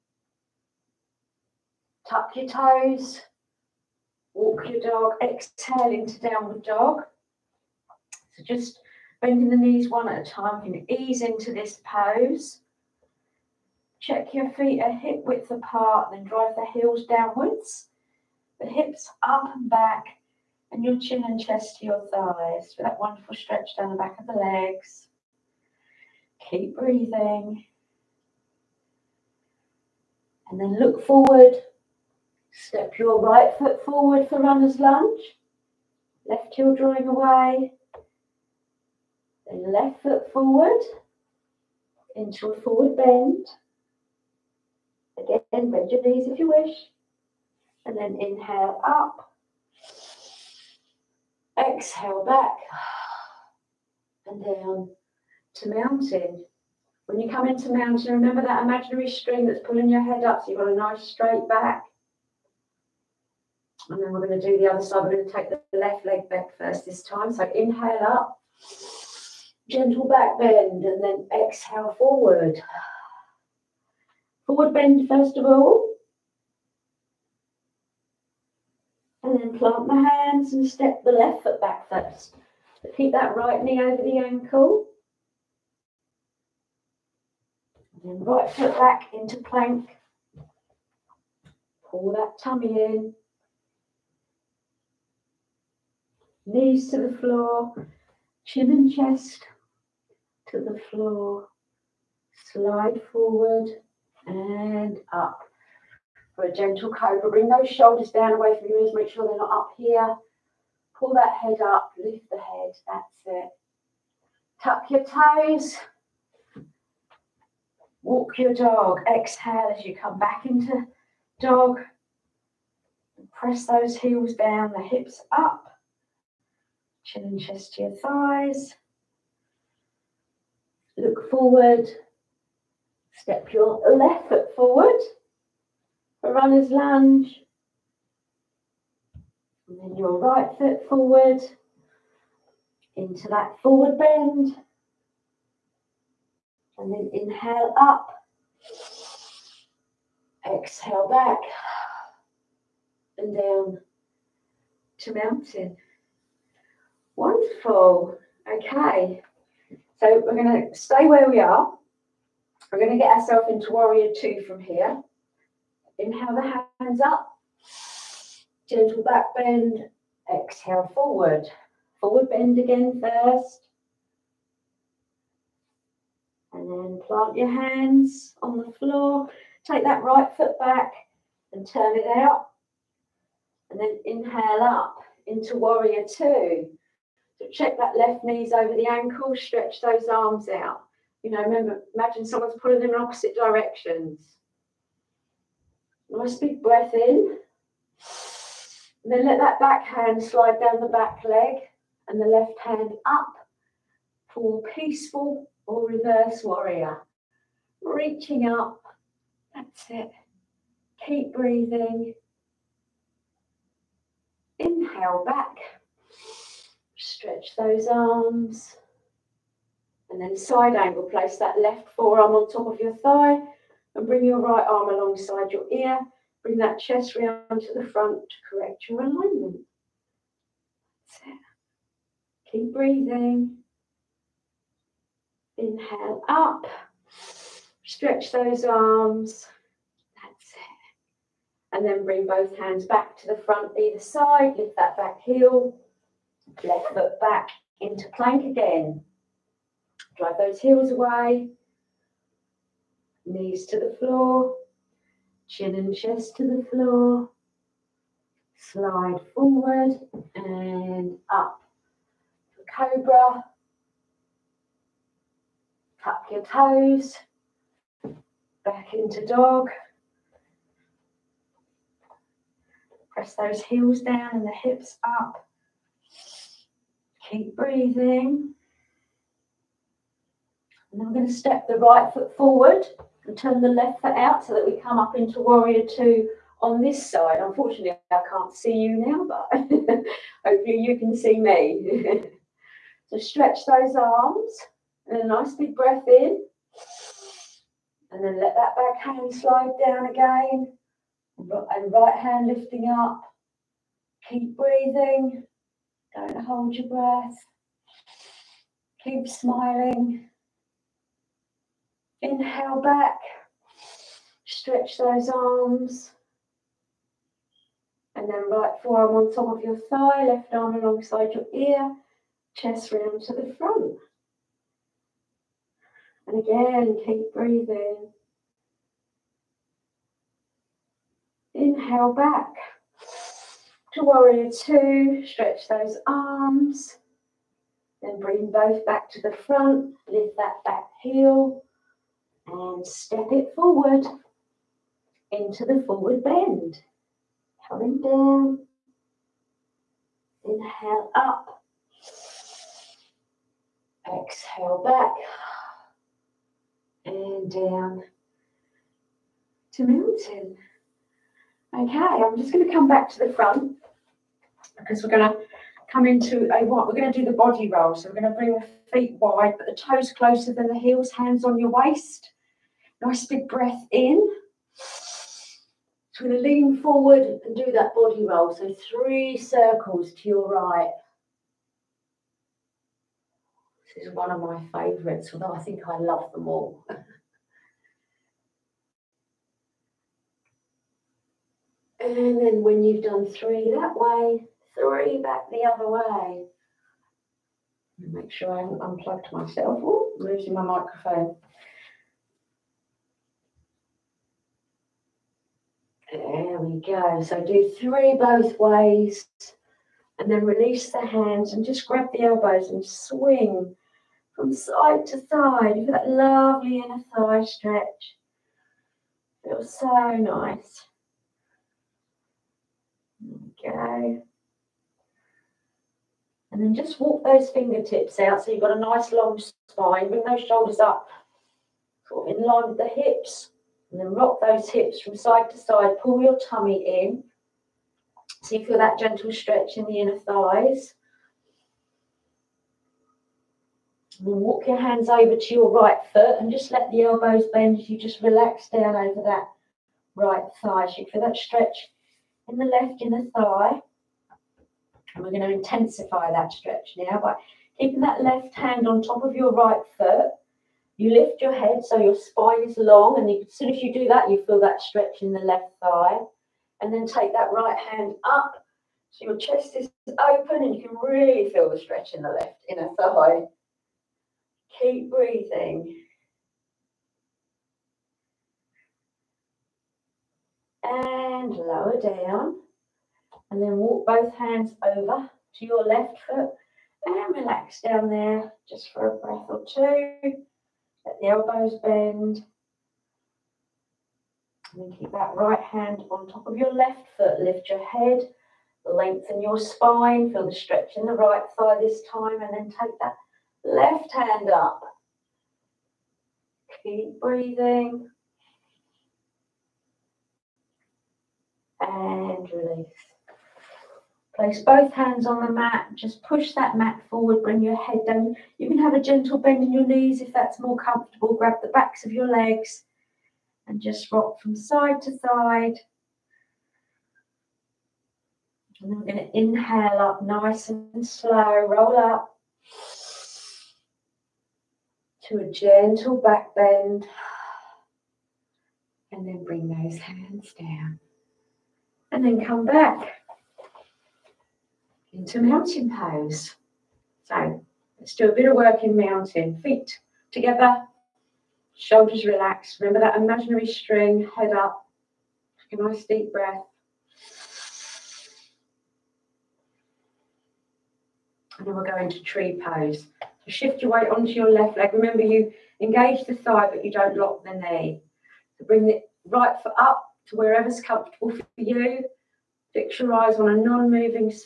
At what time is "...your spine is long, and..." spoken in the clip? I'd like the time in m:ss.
7:42.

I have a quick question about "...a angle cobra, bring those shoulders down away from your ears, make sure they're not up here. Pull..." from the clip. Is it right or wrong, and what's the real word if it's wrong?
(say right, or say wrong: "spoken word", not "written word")
wrong: "gentle", not "angle".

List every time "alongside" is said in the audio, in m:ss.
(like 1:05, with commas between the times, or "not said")
3:44, 5:20.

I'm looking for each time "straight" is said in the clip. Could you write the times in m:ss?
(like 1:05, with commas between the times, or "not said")
1:01.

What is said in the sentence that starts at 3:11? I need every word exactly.
You know, remember, imagine someone's pulling them in opposite directions.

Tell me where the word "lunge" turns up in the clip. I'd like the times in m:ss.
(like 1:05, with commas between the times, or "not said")
0:34, 2:16.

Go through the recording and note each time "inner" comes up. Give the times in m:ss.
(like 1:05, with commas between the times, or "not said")
6:56, 7:19, 7:33, 7:52.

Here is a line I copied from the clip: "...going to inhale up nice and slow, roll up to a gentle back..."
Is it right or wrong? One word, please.
right.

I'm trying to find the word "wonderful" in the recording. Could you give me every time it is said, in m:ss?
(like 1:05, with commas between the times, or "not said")
0:22, 2:37.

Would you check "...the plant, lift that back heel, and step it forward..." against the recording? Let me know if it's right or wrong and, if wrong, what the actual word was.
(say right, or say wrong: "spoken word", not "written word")
wrong: "front", not "plant".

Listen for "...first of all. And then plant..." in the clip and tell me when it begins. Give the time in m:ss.
1:15.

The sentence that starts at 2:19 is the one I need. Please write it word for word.
And then your right foot forward into that forward bend.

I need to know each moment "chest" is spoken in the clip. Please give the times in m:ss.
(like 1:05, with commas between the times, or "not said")
0:21, 1:38, 2:07, 3:46, 4:15, 5:22, 7:49.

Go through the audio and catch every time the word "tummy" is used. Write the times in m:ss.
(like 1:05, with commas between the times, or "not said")
1:32, 7:16.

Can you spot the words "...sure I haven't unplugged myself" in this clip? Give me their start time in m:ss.
6:38.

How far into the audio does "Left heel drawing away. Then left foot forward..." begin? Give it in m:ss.
0:36.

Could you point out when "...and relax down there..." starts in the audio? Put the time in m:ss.
8:07.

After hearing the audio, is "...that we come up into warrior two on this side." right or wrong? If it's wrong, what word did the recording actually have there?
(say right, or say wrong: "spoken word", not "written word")
right.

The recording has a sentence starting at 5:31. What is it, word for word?
Inhale back to warrior two, stretch those arms.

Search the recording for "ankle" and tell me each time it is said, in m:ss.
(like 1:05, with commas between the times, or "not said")
1:24, 3:08.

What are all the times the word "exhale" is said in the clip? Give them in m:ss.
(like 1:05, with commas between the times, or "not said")
0:05, 0:51, 1:11, 1:59, 2:30, 2:50, 5:54.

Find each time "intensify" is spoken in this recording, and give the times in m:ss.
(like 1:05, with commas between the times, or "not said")
7:35.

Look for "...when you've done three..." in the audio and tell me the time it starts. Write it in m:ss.
6:32.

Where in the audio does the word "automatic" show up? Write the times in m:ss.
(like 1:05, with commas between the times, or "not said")
not said.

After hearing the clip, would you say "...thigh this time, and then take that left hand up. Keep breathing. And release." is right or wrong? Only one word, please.
right.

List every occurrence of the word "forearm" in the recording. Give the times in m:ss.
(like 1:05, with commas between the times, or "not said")
3:41, 5:18.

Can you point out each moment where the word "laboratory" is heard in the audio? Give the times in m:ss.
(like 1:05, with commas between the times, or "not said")
not said.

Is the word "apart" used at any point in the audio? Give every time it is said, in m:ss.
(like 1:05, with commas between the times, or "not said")
0:15.